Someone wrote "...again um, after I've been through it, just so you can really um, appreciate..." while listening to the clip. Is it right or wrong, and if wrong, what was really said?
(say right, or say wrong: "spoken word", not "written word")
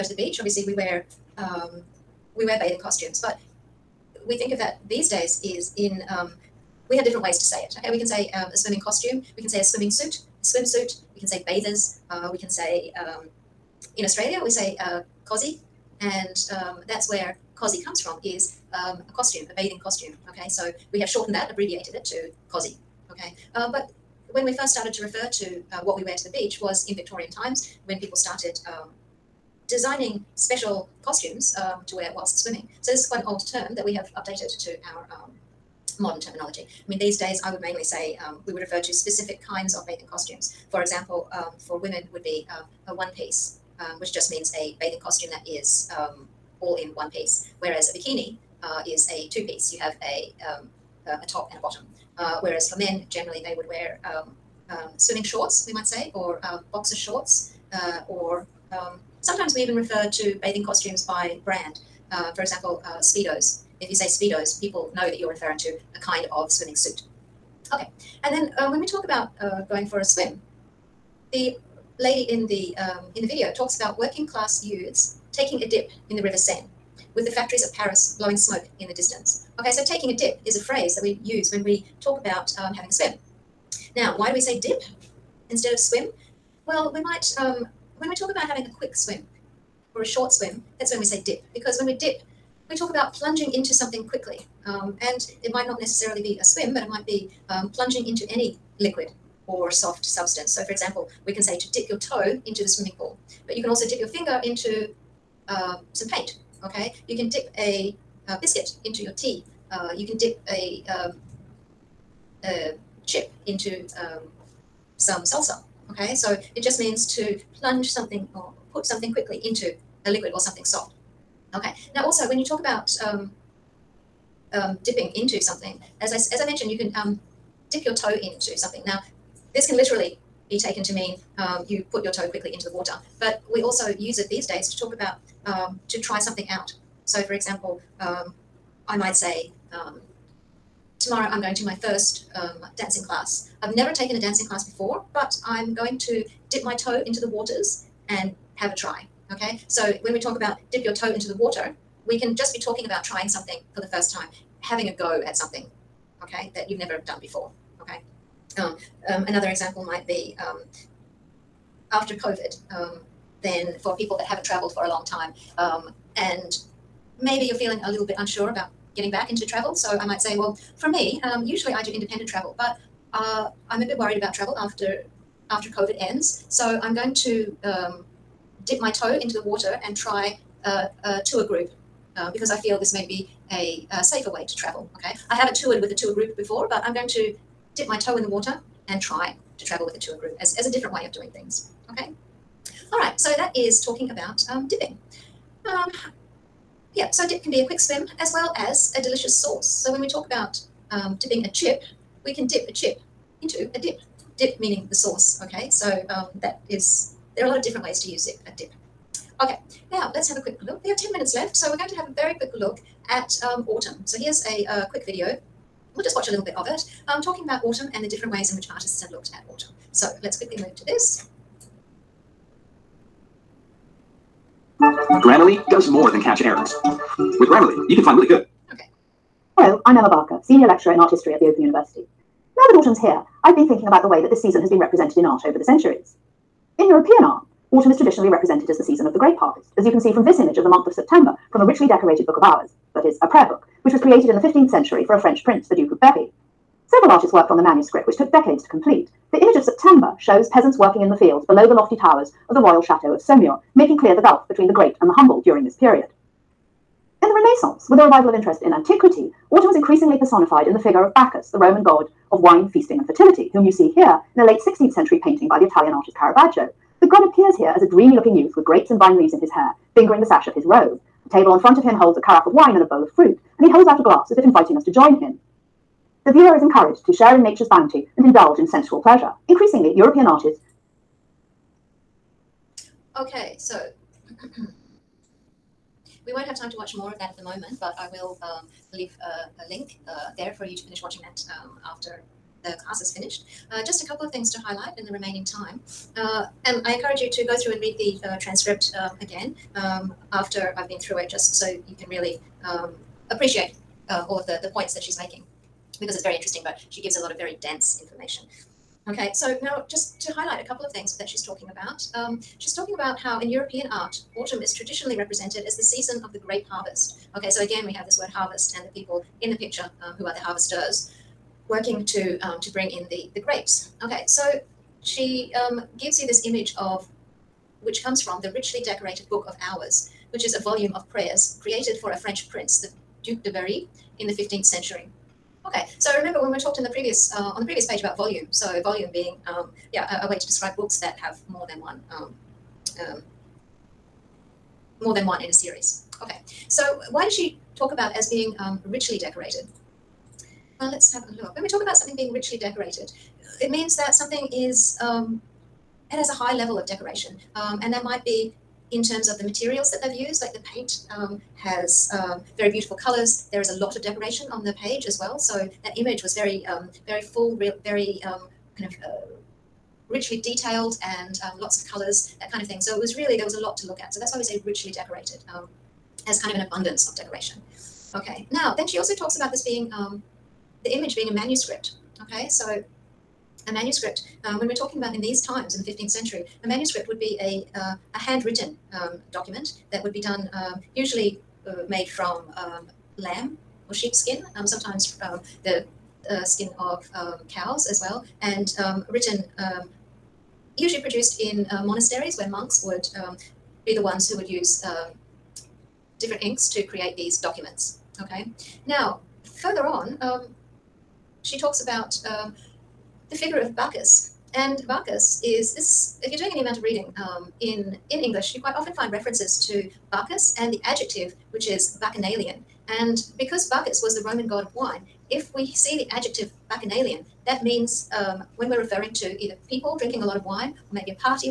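right.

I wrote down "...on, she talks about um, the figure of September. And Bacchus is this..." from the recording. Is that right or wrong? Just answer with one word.
wrong.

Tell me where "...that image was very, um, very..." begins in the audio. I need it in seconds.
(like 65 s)
365 s.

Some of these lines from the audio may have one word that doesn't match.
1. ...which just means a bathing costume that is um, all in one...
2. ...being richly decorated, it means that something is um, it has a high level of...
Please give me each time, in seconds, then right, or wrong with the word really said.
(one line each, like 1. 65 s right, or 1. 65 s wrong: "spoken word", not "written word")
1. 44 s right
2. 352 s right.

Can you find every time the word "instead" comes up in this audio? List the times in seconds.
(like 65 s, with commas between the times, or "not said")
85 s.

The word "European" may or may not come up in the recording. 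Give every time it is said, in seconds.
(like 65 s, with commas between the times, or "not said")
236 s, 279 s, 313 s.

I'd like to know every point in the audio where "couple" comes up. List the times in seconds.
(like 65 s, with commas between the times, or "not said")
294 s, 310 s.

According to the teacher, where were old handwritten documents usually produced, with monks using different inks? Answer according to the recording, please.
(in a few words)
monasteries.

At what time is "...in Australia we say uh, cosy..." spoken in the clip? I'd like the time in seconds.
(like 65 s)
13 s.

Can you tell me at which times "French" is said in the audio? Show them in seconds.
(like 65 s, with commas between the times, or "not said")
245 s, 332 s.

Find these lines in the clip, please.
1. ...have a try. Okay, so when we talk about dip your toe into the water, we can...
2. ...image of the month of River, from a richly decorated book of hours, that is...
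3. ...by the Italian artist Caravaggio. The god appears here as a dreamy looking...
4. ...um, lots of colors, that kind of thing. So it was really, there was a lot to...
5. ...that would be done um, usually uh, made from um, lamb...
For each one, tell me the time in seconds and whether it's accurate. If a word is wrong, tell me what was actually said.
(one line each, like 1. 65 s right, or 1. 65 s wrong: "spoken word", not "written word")
1. 148 s right
2. 240 s wrong: "September", not "River"
3. 265 s right
4. 371 s right
5. 389 s right.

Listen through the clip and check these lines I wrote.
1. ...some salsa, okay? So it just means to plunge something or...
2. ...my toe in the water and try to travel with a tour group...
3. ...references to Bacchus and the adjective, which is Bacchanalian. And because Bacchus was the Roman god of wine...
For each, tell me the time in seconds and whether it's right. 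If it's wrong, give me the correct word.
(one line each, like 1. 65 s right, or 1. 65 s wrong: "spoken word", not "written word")
1. 114 s right
2. 187 s right
3. 419 s right.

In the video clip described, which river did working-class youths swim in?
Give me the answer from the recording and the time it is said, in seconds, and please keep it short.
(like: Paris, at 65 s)
River Seine, at 76 s.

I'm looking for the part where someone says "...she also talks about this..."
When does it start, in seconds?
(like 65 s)
378 s.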